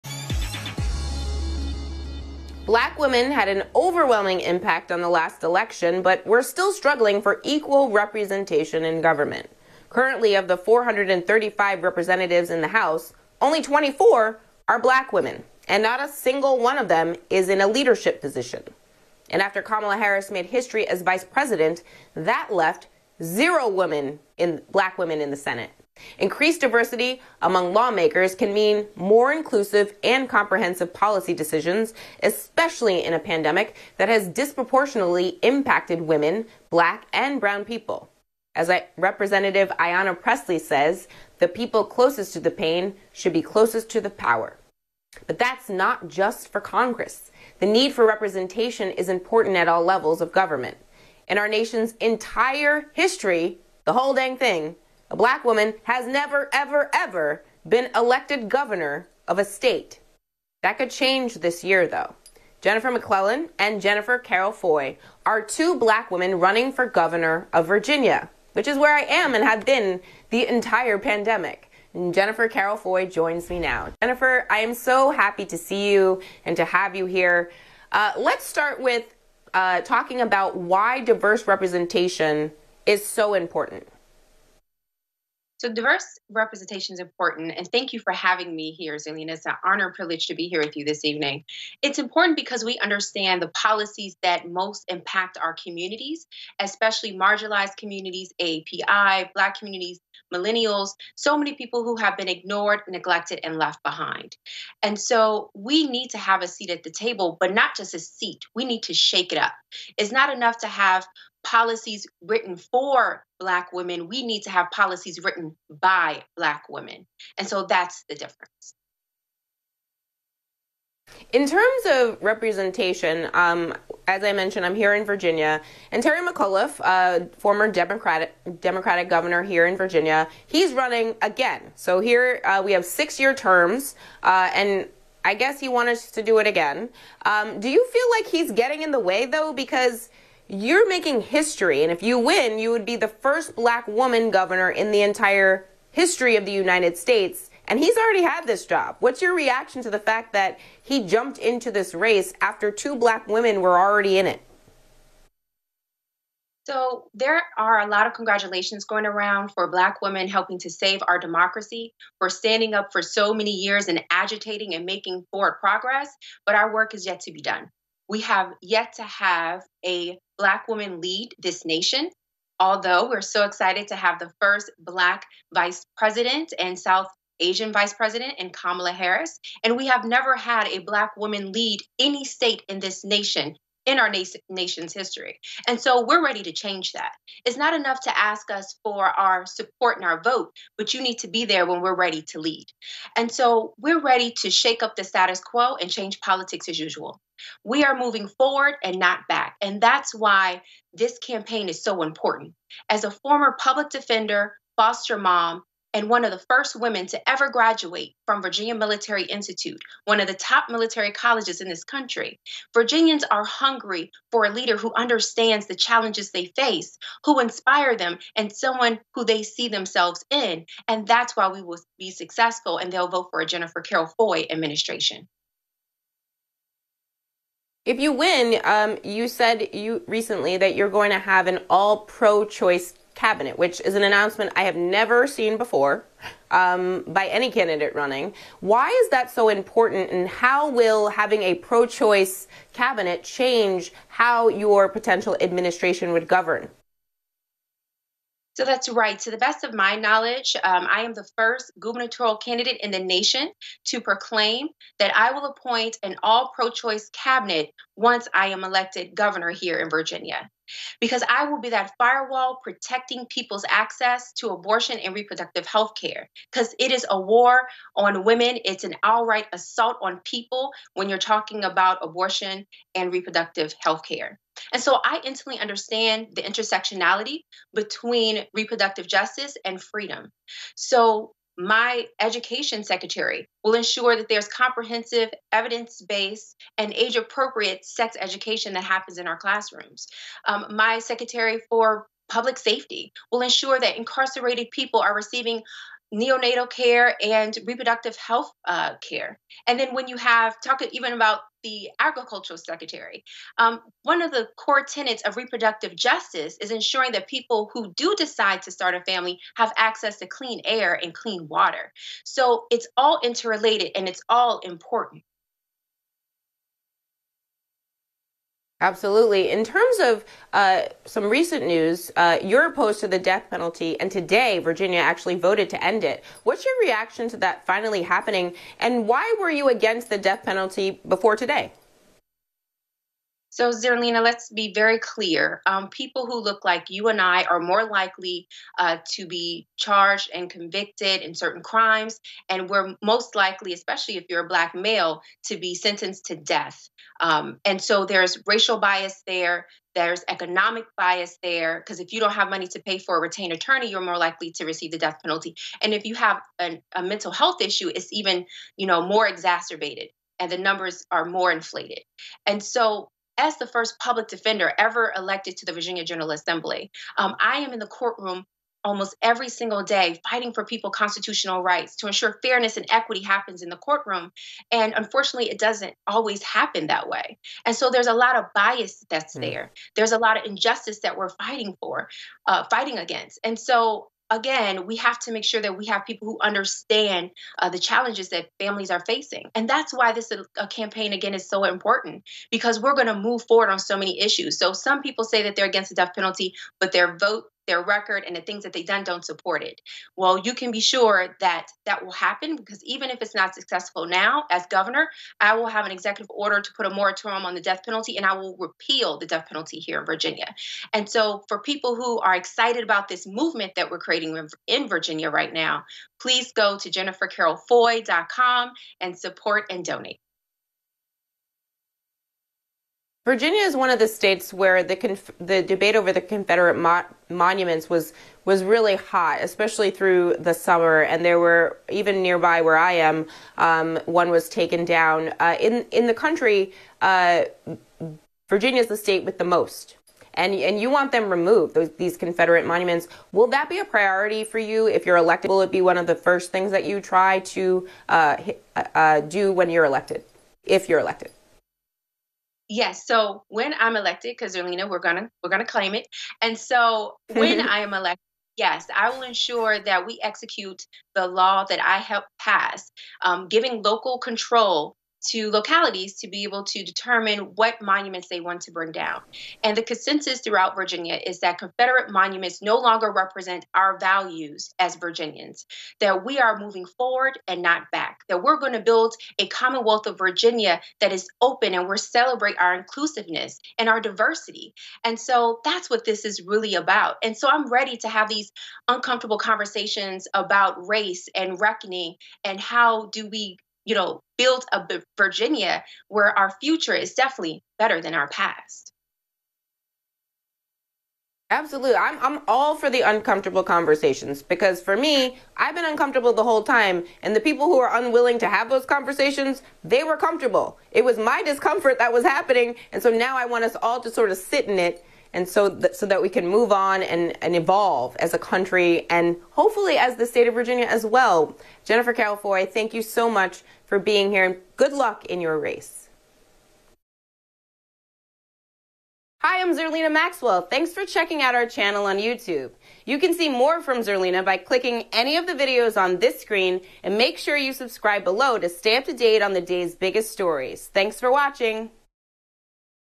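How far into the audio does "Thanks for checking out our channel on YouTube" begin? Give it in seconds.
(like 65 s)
530 s.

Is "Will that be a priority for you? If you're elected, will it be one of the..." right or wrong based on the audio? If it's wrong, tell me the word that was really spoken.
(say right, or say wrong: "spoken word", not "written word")
right.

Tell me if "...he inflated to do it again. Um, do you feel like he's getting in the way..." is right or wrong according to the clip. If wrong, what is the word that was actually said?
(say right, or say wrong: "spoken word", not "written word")
wrong: "wanted", not "inflated".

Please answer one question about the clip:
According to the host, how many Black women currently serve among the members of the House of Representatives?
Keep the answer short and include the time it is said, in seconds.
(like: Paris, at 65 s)
24, at 13 s.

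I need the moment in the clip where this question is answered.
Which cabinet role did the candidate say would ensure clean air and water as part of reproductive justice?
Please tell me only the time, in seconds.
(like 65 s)
301 s.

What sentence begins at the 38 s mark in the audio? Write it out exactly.
As I, Representative Ayanna Pressley says, the people closest to the pain should be closest to the power.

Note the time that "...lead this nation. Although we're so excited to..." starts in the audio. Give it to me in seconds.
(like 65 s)
170 s.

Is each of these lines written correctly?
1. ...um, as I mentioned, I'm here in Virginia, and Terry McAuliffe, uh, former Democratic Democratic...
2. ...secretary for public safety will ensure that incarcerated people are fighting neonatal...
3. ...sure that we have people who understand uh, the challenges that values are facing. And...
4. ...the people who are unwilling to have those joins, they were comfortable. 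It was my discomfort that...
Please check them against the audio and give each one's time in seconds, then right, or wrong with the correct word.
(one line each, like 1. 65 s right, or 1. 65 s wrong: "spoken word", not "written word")
1. 123 s right
2. 290 s wrong: "receiving", not "fighting"
3. 385 s wrong: "families", not "values"
4. 507 s wrong: "conversations", not "joins".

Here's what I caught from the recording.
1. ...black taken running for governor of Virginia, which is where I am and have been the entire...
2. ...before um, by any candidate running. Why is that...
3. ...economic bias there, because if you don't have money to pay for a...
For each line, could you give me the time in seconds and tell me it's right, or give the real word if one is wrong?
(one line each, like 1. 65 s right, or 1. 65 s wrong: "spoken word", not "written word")
1. 65 s wrong: "women", not "taken"
2. 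235 s right
3. 350 s right.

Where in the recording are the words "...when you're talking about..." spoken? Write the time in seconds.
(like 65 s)
270 s.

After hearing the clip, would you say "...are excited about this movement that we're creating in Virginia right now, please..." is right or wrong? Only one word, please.
right.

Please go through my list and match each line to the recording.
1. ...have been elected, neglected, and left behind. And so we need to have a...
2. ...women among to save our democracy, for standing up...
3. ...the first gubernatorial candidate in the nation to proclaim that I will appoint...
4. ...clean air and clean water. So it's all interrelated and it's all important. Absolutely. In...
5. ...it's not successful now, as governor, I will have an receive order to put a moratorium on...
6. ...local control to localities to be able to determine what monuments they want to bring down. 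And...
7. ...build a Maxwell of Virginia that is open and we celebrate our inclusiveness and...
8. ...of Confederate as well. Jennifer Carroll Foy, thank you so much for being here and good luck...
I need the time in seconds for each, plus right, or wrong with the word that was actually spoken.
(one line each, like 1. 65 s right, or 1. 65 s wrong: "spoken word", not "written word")
1. 101 s wrong: "ignored", not "elected"
2. 159 s wrong: "helping", not "among"
3. 251 s right
4. 310 s right
5. 403 s wrong: "executive", not "receive"
6. 463 s right
7. 478 s wrong: "Commonwealth", not "Maxwell"
8. 520 s wrong: "Virginia", not "Confederate".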